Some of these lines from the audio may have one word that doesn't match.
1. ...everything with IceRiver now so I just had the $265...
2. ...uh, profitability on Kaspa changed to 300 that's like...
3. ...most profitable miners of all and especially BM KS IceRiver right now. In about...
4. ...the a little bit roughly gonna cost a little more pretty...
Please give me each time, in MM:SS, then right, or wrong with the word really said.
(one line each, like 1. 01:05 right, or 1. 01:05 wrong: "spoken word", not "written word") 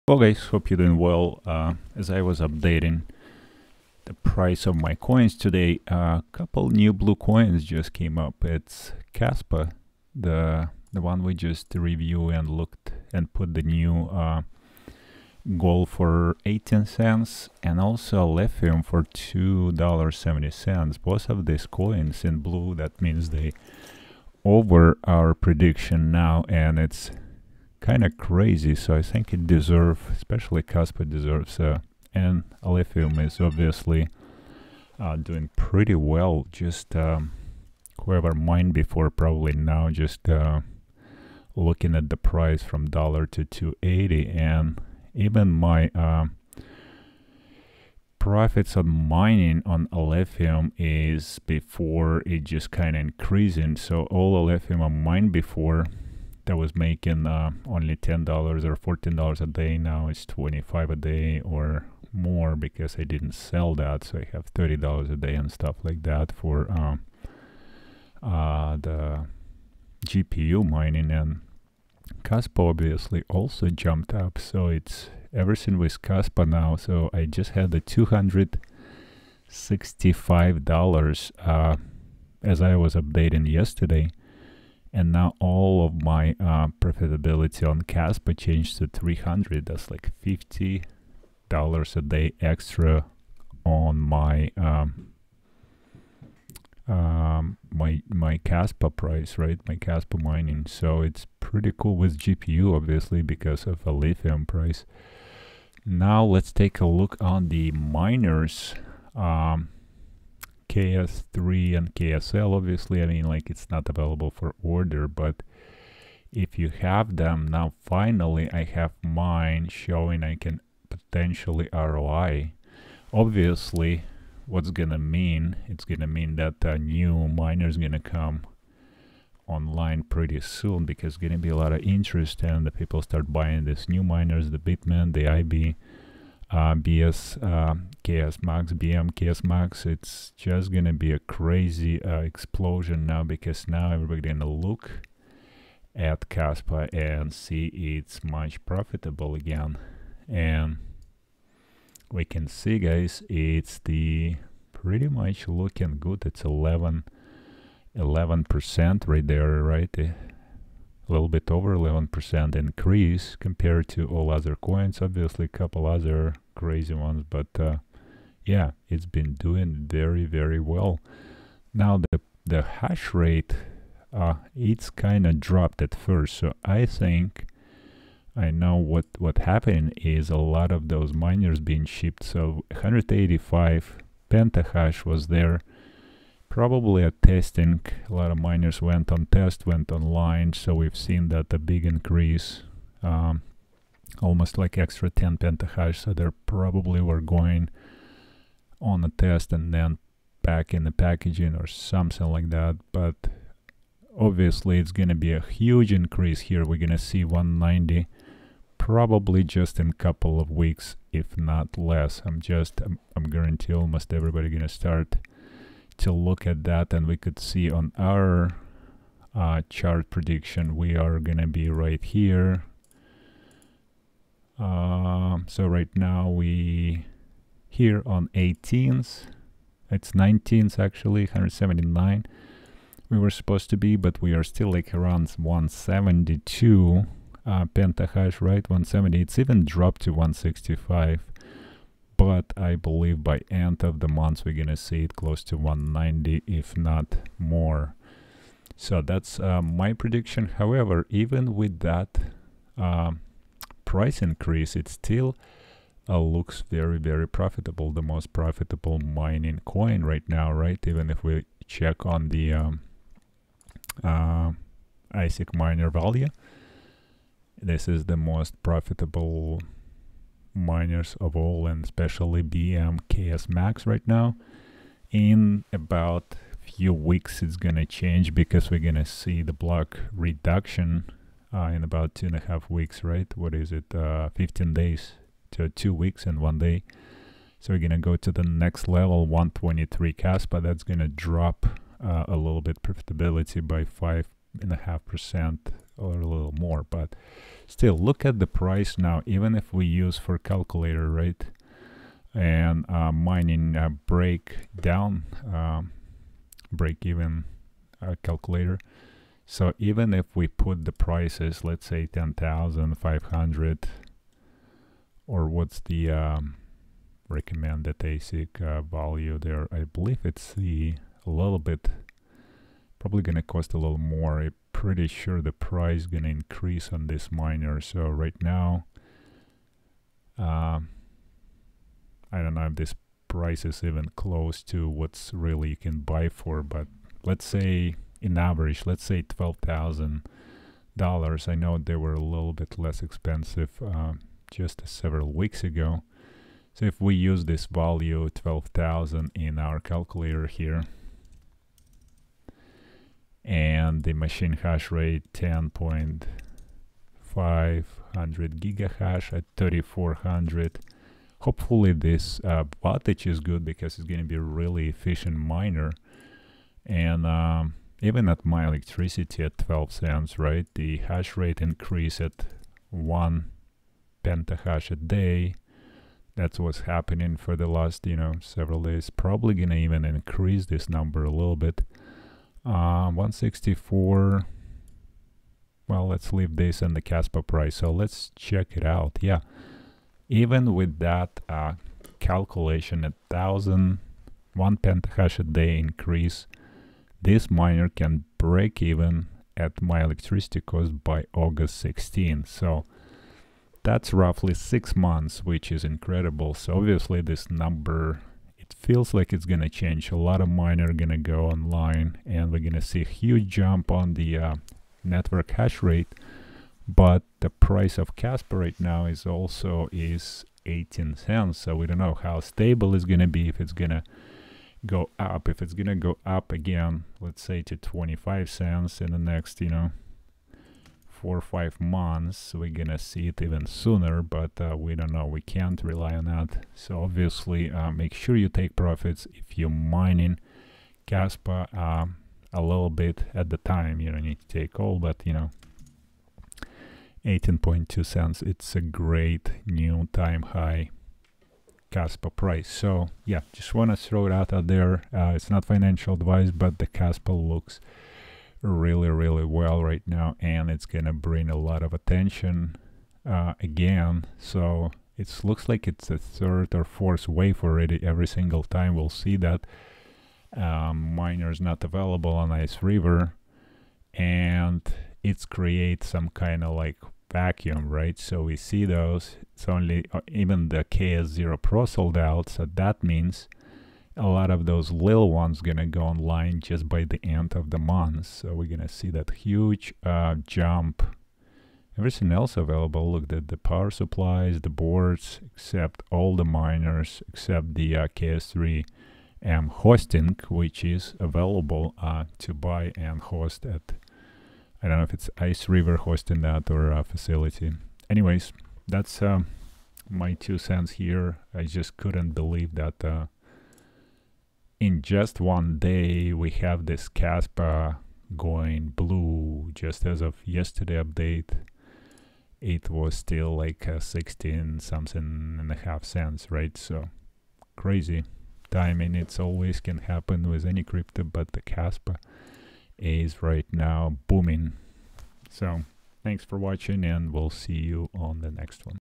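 1. 01:15 wrong: "Kaspa", not "IceRiver"
2. 01:26 right
3. 04:28 wrong: "Max", not "IceRiver"
4. 05:20 wrong: "probably", not "roughly".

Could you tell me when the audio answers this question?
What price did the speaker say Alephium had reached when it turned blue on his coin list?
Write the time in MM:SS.
00:19.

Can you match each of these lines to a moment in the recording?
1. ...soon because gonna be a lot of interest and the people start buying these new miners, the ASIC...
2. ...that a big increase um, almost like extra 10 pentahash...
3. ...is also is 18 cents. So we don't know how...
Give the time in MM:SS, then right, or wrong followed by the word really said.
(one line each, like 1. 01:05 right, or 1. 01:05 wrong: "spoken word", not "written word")
1. 02:10 wrong: "Bitmain", not "ASIC"
2. 03:11 right
3. 06:59 right.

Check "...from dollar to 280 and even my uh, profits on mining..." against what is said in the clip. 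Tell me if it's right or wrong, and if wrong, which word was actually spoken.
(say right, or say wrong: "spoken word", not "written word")
right.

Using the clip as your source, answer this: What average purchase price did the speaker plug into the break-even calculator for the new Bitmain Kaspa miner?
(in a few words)
$12,000.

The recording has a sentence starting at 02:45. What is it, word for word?
Obviously, a couple other crazy ones, but uh, yeah, it's been doing very, very well.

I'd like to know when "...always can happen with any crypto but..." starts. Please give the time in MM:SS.
08:49.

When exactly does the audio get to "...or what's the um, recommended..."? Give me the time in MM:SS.
05:15.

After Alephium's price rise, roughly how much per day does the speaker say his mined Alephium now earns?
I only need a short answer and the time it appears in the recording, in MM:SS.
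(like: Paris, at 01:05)
$30 a day, at 01:04.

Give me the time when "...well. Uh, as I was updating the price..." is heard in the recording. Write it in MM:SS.
00:00.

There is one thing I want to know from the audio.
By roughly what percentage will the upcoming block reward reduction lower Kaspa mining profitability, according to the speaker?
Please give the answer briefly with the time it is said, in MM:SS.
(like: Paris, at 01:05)
5.5%, at 04:53.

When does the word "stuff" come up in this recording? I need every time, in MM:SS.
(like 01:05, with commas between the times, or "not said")
01:05.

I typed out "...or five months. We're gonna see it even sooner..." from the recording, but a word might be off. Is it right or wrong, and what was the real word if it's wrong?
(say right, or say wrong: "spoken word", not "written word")
right.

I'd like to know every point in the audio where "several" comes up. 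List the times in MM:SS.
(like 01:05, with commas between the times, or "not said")
05:44, 06:18.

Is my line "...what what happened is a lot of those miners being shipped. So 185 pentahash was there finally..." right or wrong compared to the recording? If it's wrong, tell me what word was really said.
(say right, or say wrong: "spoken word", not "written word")
wrong: "probably", not "finally".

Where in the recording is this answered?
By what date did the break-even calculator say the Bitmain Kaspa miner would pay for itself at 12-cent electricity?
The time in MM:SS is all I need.
06:41.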